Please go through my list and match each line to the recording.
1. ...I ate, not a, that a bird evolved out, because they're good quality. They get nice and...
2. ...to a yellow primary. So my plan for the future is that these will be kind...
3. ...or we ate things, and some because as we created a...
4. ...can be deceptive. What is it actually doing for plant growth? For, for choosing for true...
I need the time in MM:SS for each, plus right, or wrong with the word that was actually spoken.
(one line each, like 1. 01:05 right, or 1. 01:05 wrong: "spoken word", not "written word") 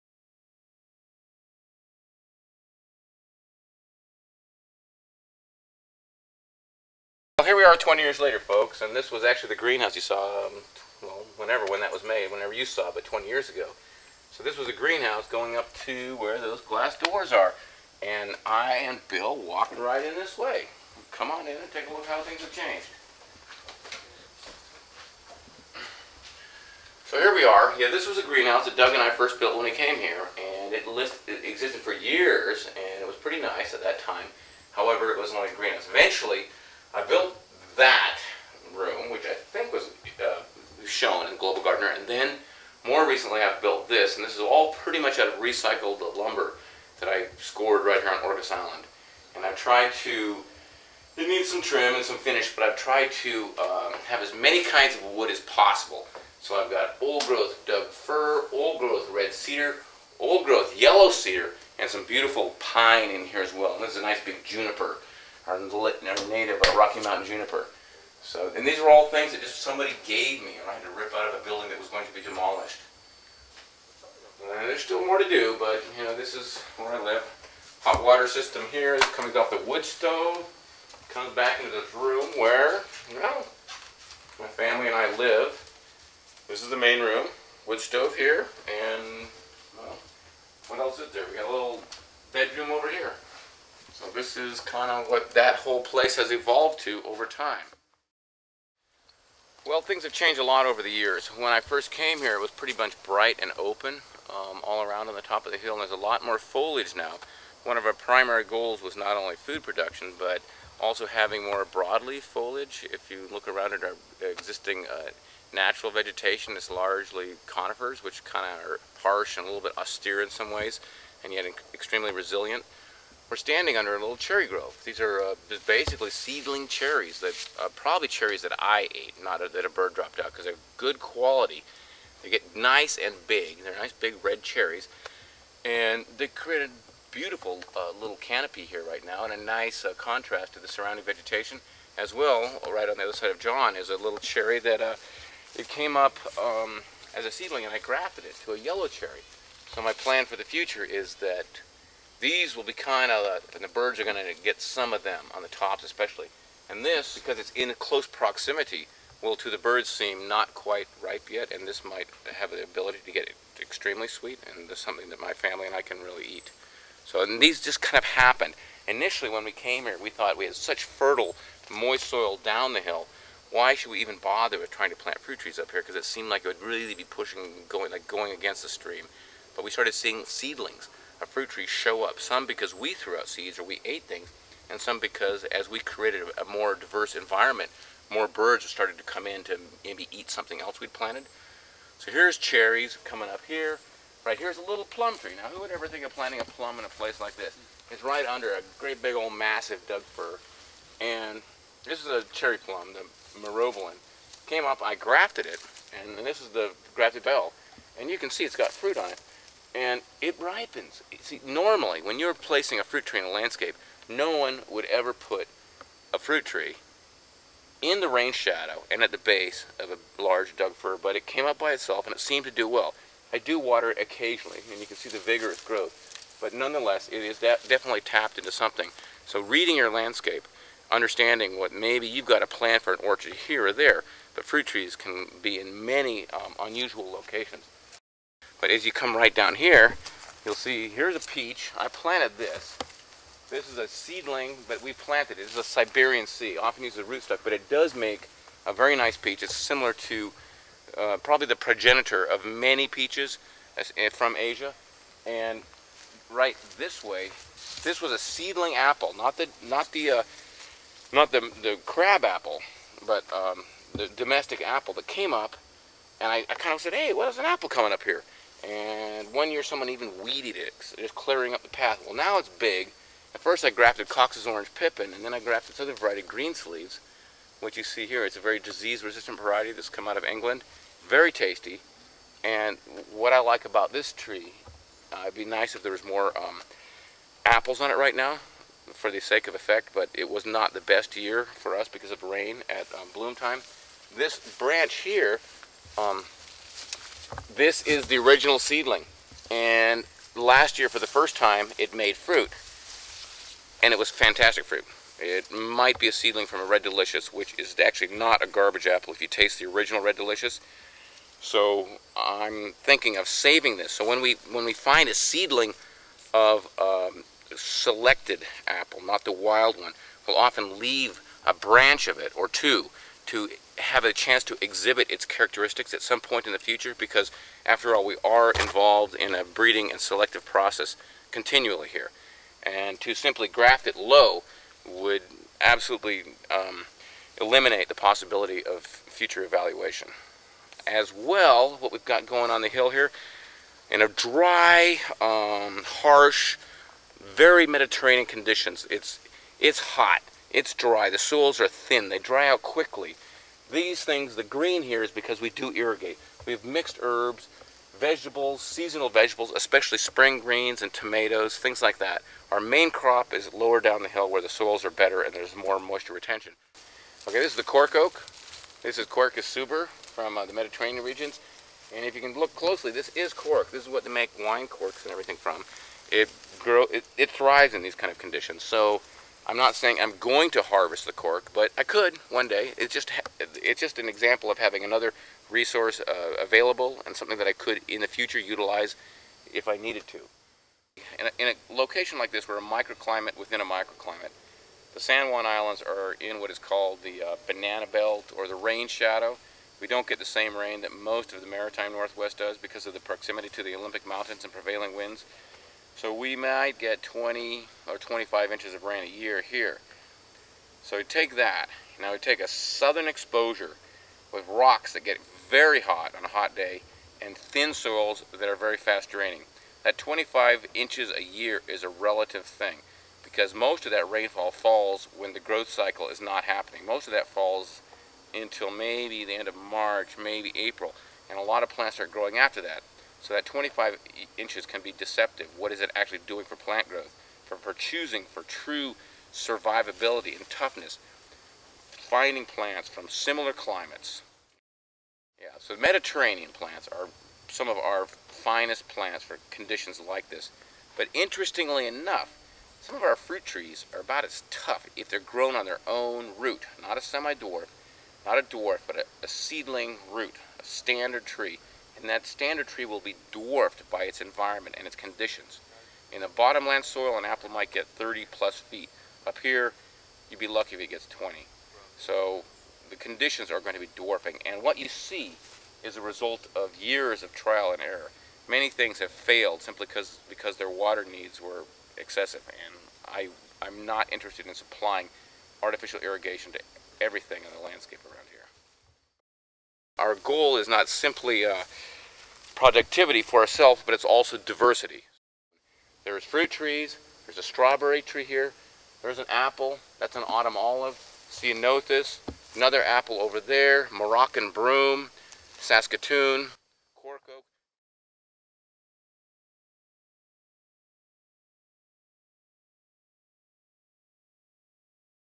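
1. 02:08 wrong: "dropped", not "evolved"
2. 02:28 wrong: "cherry", not "primary"
3. 03:03 right
4. 07:14 right.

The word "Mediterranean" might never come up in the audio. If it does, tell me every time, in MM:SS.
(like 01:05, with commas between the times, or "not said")
05:47, 06:10, 07:25.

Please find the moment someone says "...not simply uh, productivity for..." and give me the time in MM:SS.
08:10.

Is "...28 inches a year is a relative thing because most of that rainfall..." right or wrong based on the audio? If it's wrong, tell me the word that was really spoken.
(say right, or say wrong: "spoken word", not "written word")
wrong: "25", not "28".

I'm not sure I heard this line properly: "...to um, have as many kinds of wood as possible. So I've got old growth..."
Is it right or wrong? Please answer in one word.
right.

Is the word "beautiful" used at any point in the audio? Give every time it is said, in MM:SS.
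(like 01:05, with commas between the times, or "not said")
01:02, 02:17.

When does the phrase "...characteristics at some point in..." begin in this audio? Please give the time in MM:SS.
05:25.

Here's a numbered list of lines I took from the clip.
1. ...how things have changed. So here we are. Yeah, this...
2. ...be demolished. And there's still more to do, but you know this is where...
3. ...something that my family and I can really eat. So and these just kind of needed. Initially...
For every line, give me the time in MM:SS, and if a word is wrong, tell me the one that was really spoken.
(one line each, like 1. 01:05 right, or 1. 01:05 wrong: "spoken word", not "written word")
1. 00:22 right
2. 01:12 right
3. 02:44 wrong: "happened", not "needed".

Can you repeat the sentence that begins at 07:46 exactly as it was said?
In a bottomland soil, an apple might get 30 plus feet.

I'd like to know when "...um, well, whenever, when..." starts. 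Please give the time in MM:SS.
00:10.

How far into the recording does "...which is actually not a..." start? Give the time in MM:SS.
05:07.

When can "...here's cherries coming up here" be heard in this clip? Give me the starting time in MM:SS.
03:12.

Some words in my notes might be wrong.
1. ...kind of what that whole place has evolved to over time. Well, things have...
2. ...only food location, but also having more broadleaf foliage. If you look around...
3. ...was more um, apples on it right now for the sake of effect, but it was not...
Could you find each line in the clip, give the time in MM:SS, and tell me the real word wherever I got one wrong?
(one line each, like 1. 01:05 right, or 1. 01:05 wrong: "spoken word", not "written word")
1. 01:34 right
2. 01:49 wrong: "production", not "location"
3. 04:45 right.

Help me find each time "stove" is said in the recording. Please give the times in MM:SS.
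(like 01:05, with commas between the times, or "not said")
01:19, 01:27.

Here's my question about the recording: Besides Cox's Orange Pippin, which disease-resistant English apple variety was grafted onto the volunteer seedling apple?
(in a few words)
Sleeves.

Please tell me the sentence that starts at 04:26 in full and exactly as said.
And I, I kind of said, hey, what is an apple coming up here?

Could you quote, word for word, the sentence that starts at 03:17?
It's right under a great big old massive Doug fir.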